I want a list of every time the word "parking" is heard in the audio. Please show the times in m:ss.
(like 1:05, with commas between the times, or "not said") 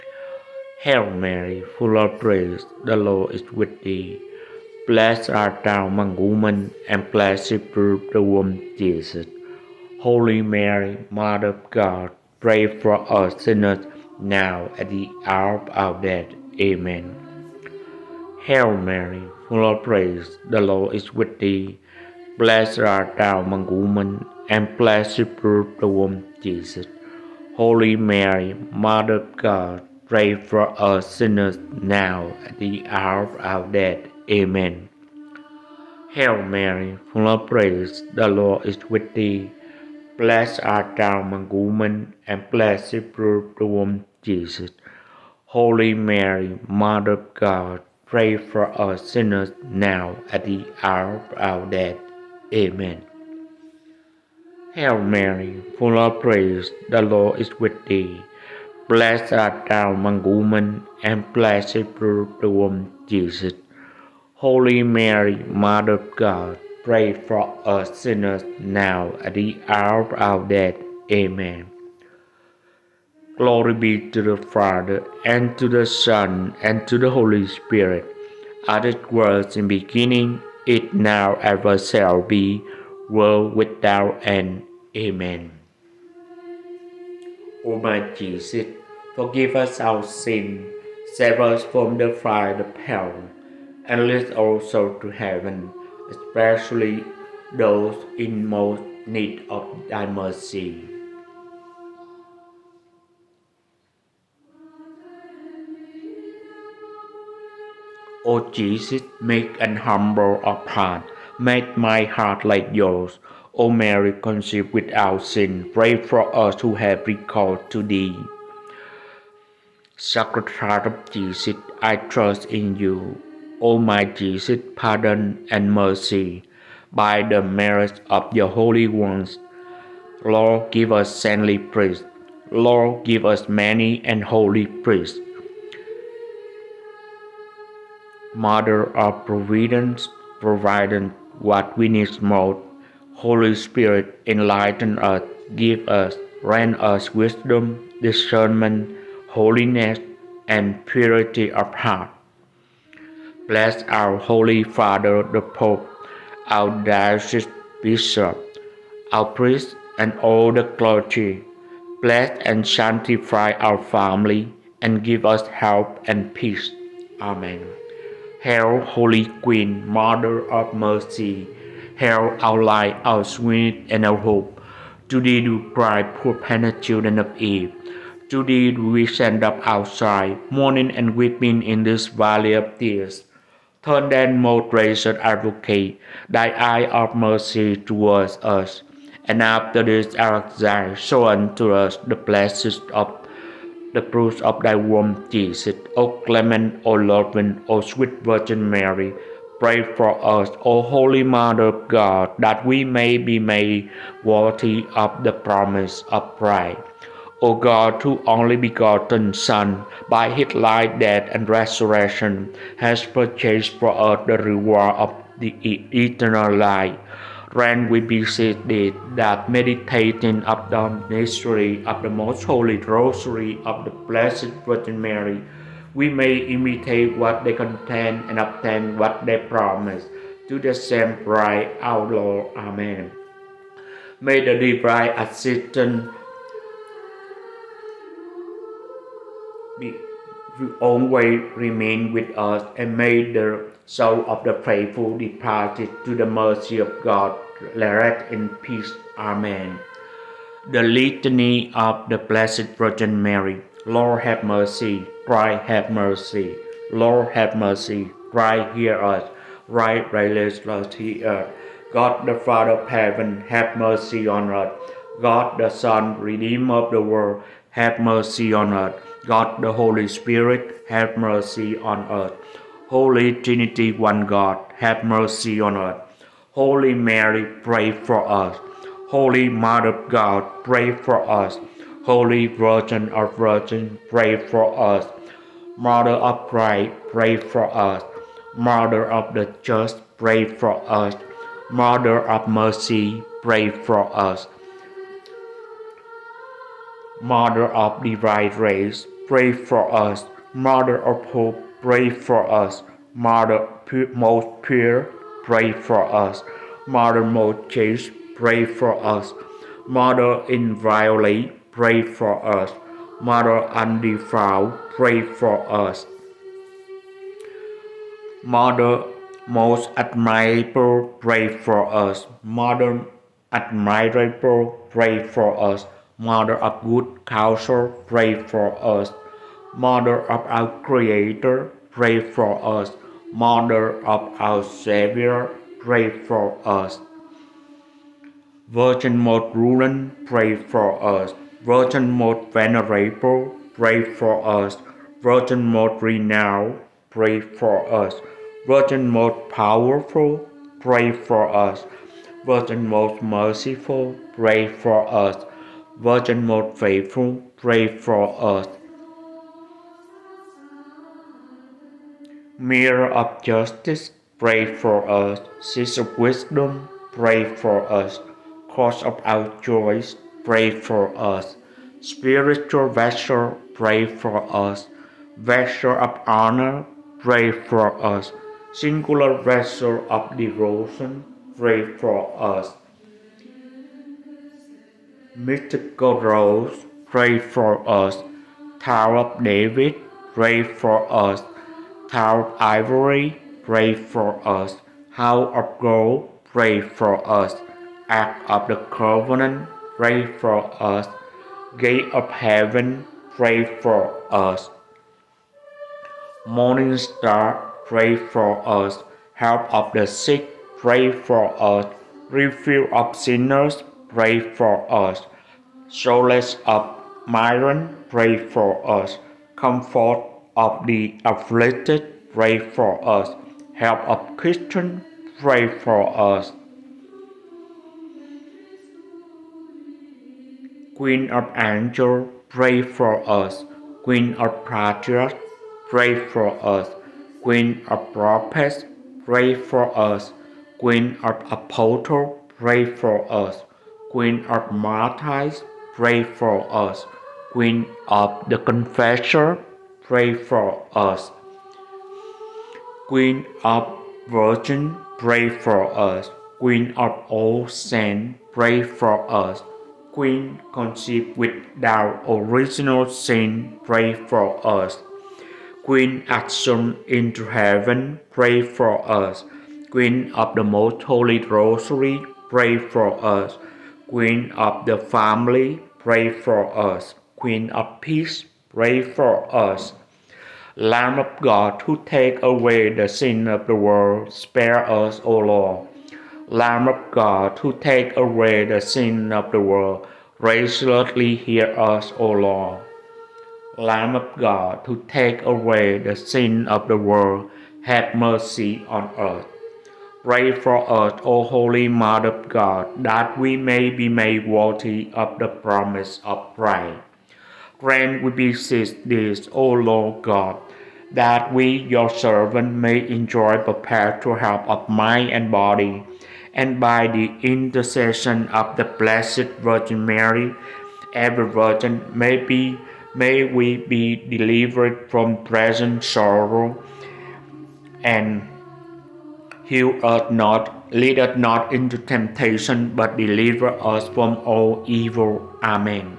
not said.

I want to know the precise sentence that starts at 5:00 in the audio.
Mother of hope, pray for us.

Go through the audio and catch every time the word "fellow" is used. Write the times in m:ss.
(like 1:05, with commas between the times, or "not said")
not said.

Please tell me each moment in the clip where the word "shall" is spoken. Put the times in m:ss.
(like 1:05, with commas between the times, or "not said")
1:21.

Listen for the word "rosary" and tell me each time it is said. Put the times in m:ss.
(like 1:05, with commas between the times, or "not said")
3:42, 7:51.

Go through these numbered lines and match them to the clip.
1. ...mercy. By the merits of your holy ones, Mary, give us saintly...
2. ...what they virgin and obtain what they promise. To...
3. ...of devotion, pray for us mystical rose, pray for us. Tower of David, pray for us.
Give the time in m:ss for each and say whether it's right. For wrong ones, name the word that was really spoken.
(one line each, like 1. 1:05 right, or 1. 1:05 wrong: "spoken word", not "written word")
1. 2:05 wrong: "Lord", not "Mary"
2. 3:47 wrong: "contain", not "virgin"
3. 6:20 right.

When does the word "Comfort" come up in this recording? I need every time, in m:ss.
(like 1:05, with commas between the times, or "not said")
6:59.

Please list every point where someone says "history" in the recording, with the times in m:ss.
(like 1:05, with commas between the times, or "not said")
not said.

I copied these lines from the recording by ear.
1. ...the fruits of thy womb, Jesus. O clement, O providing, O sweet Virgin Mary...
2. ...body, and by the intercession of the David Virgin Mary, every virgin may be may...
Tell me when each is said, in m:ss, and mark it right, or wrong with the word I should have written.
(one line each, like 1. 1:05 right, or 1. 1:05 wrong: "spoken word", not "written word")
1. 3:13 wrong: "loving", not "providing"
2. 8:35 wrong: "Blessed", not "David".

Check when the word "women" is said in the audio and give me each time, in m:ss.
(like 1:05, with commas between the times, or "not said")
0:06, 0:23, 0:41, 1:00.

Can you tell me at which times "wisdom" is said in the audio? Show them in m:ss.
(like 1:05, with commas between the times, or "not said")
2:27, 6:06.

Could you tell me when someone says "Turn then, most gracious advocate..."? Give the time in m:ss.
3:03.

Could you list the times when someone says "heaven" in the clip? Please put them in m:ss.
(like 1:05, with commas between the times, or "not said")
1:35, 4:22, 6:42, 7:47.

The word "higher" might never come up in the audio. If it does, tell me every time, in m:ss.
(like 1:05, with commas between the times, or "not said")
not said.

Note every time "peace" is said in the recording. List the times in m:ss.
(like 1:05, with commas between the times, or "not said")
2:46, 4:08, 7:58.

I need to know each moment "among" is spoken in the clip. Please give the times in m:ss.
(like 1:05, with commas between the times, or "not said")
0:05, 0:23, 0:41, 0:59.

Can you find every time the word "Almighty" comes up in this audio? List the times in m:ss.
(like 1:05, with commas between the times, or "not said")
not said.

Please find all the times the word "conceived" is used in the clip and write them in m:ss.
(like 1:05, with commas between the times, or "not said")
1:54, 7:40.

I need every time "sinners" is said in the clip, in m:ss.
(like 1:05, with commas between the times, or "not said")
0:13, 0:31, 0:49, 1:07, 6:53.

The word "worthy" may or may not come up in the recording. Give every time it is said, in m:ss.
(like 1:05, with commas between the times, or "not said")
3:24, 8:24.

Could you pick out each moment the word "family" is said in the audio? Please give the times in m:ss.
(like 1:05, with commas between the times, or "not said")
2:43, 7:54.